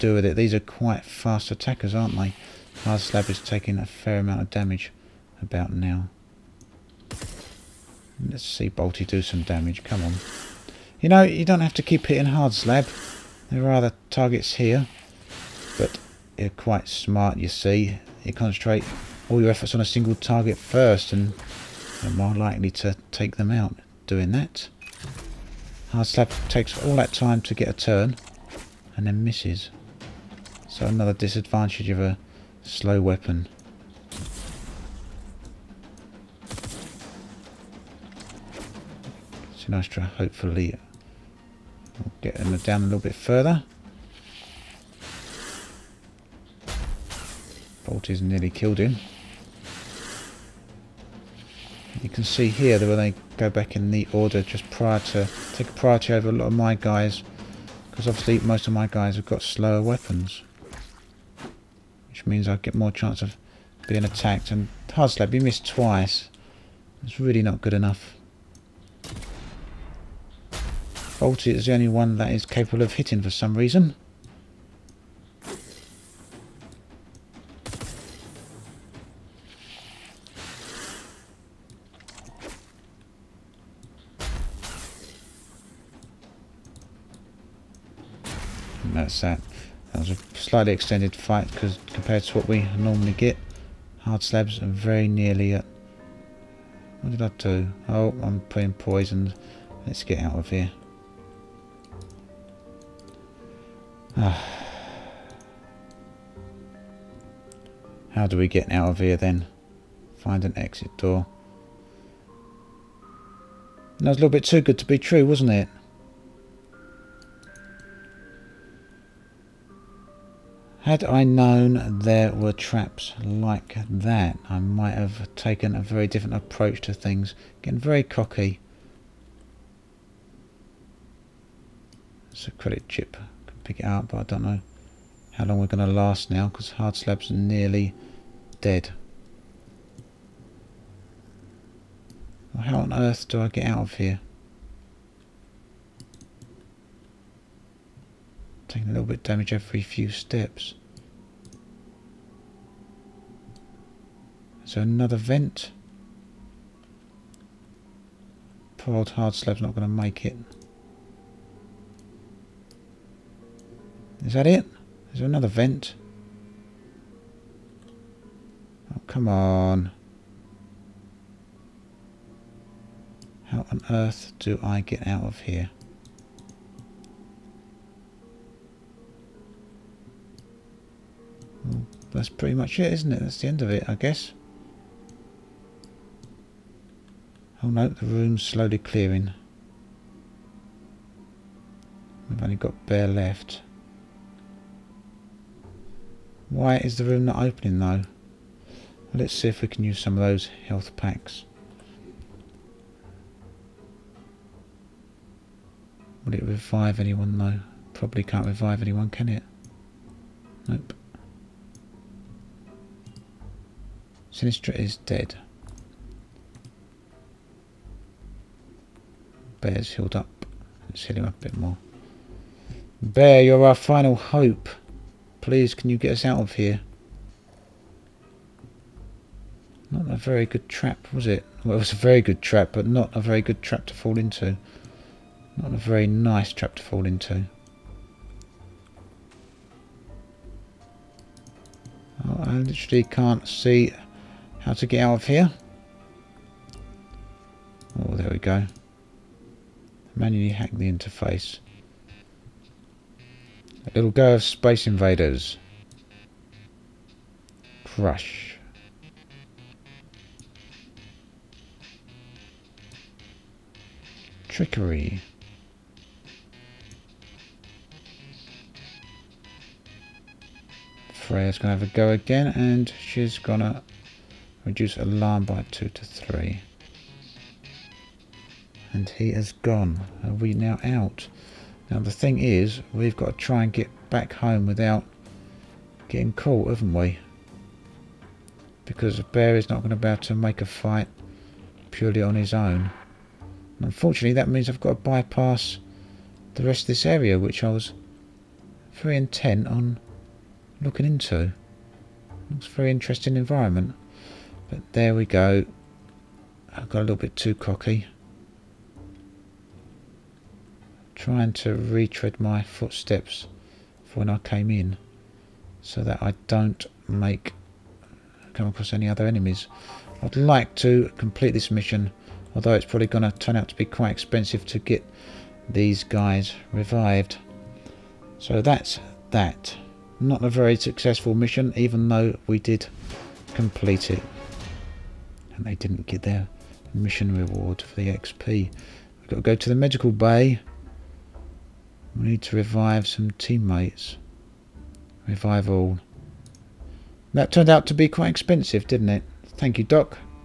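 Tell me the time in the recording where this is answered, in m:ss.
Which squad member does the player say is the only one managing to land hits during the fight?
1:10.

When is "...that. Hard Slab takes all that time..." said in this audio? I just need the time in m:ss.
0:24.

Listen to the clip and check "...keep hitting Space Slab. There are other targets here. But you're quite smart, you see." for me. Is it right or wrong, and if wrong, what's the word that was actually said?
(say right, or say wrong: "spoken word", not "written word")
wrong: "Hard", not "Space".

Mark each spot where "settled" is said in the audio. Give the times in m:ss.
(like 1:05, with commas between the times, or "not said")
not said.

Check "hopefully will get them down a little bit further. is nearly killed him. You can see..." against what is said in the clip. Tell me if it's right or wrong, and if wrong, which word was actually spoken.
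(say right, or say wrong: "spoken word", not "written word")
right.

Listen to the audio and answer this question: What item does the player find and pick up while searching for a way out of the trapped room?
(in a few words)
Credit chip.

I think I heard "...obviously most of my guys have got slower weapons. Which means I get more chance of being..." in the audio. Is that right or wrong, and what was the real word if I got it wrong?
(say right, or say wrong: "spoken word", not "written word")
right.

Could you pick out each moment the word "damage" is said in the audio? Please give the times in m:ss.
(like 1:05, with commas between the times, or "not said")
0:04, 0:09, 2:29.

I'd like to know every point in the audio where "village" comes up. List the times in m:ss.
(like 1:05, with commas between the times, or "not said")
not said.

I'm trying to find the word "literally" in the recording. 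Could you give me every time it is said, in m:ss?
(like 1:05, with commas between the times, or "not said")
4:02.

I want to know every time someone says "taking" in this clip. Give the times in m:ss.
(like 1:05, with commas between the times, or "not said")
0:03, 2:28.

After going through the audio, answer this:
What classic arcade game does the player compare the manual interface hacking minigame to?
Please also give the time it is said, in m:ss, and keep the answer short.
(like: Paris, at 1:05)
Space Invaders, at 4:14.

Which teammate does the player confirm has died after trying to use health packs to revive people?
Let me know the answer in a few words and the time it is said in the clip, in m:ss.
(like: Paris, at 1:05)
Sinistra, at 3:34.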